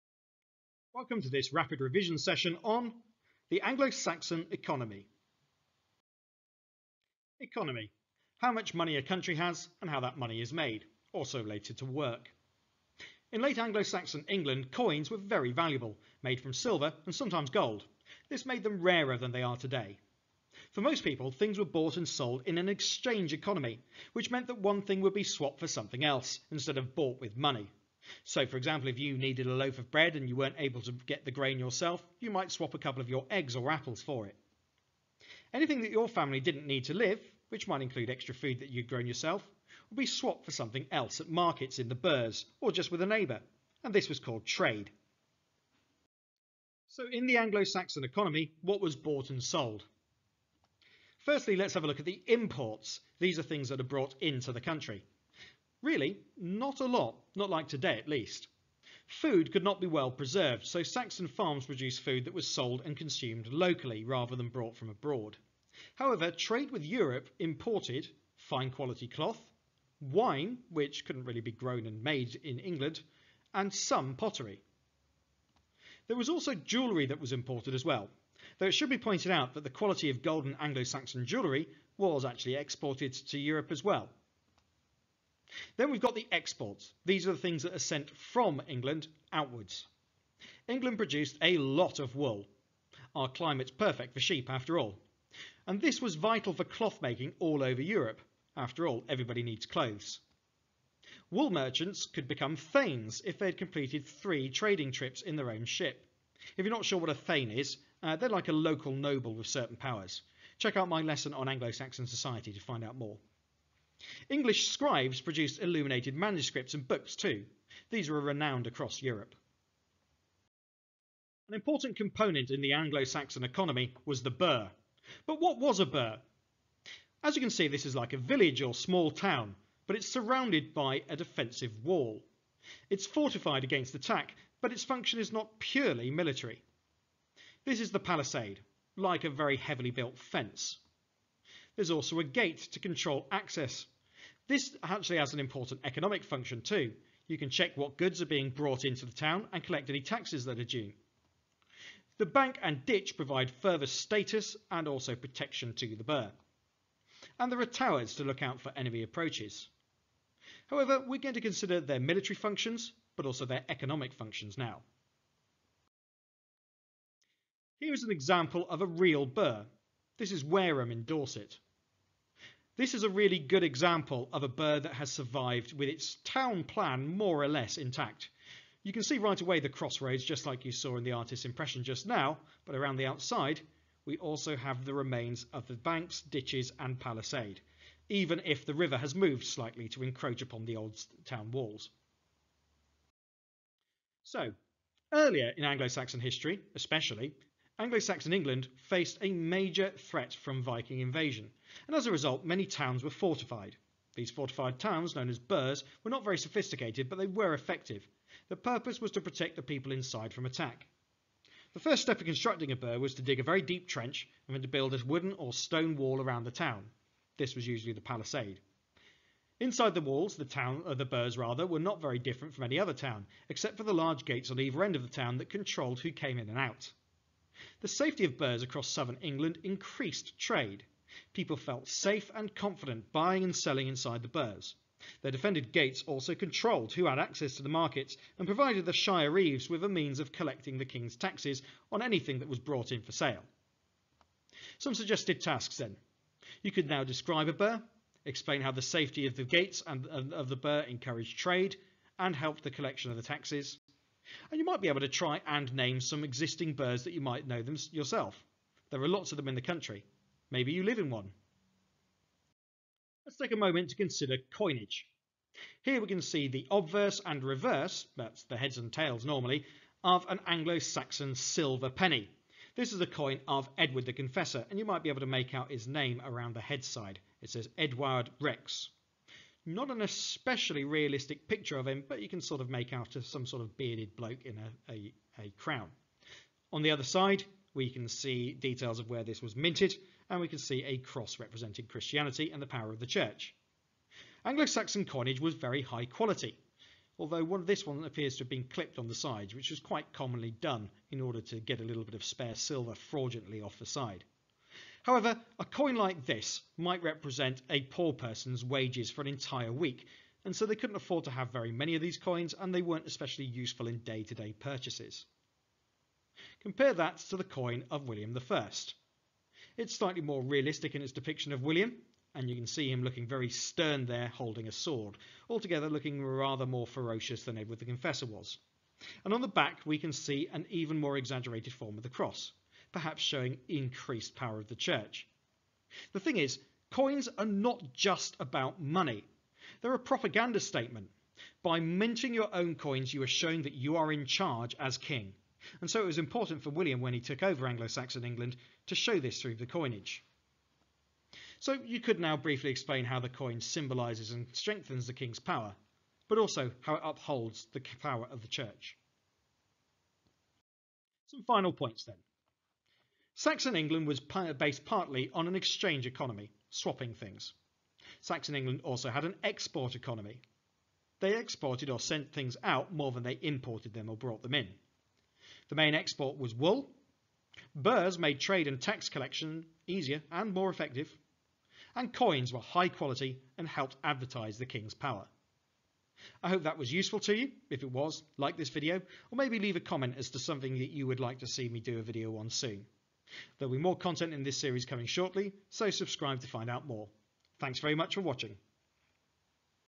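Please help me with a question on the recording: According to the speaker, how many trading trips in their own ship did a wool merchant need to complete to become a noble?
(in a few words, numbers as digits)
3.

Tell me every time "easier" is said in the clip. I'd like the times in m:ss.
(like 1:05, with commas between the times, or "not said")
6:19.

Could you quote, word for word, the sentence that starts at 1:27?
These are the things that are sent from England outwards.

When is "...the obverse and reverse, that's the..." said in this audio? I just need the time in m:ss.
4:26.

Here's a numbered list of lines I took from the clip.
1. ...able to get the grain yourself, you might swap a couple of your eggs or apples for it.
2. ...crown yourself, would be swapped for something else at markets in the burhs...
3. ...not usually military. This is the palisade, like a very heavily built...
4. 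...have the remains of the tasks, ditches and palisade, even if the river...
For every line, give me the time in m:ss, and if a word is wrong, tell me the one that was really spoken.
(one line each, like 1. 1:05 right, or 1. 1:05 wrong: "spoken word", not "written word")
1. 0:30 right
2. 0:38 wrong: "grown", not "crown"
3. 2:15 wrong: "purely", not "usually"
4. 3:04 wrong: "banks", not "tasks".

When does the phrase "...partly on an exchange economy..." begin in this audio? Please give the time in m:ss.
6:04.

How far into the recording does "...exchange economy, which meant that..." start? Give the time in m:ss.
0:22.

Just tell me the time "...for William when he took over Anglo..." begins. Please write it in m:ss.
5:46.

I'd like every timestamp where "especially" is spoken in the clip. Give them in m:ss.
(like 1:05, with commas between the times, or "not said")
3:16, 4:40, 5:13.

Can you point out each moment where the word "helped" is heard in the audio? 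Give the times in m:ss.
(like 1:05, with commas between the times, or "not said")
4:12, 6:23.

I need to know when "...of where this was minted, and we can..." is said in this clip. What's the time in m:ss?
4:48.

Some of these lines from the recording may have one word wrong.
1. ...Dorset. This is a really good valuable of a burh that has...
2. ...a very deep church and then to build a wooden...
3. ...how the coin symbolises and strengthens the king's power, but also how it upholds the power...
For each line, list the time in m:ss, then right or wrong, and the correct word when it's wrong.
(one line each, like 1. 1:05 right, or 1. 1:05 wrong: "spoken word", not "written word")
1. 2:51 wrong: "example", not "valuable"
2. 3:33 wrong: "trench", not "church"
3. 5:53 right.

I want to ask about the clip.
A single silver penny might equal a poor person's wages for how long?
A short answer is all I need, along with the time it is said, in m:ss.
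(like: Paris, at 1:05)
An entire week, at 5:09.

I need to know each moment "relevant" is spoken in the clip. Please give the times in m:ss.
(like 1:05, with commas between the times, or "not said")
not said.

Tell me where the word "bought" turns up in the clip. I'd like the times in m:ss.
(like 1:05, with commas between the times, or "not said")
0:21, 0:26, 0:48.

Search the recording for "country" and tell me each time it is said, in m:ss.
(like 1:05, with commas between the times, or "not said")
0:09, 0:54, 4:19.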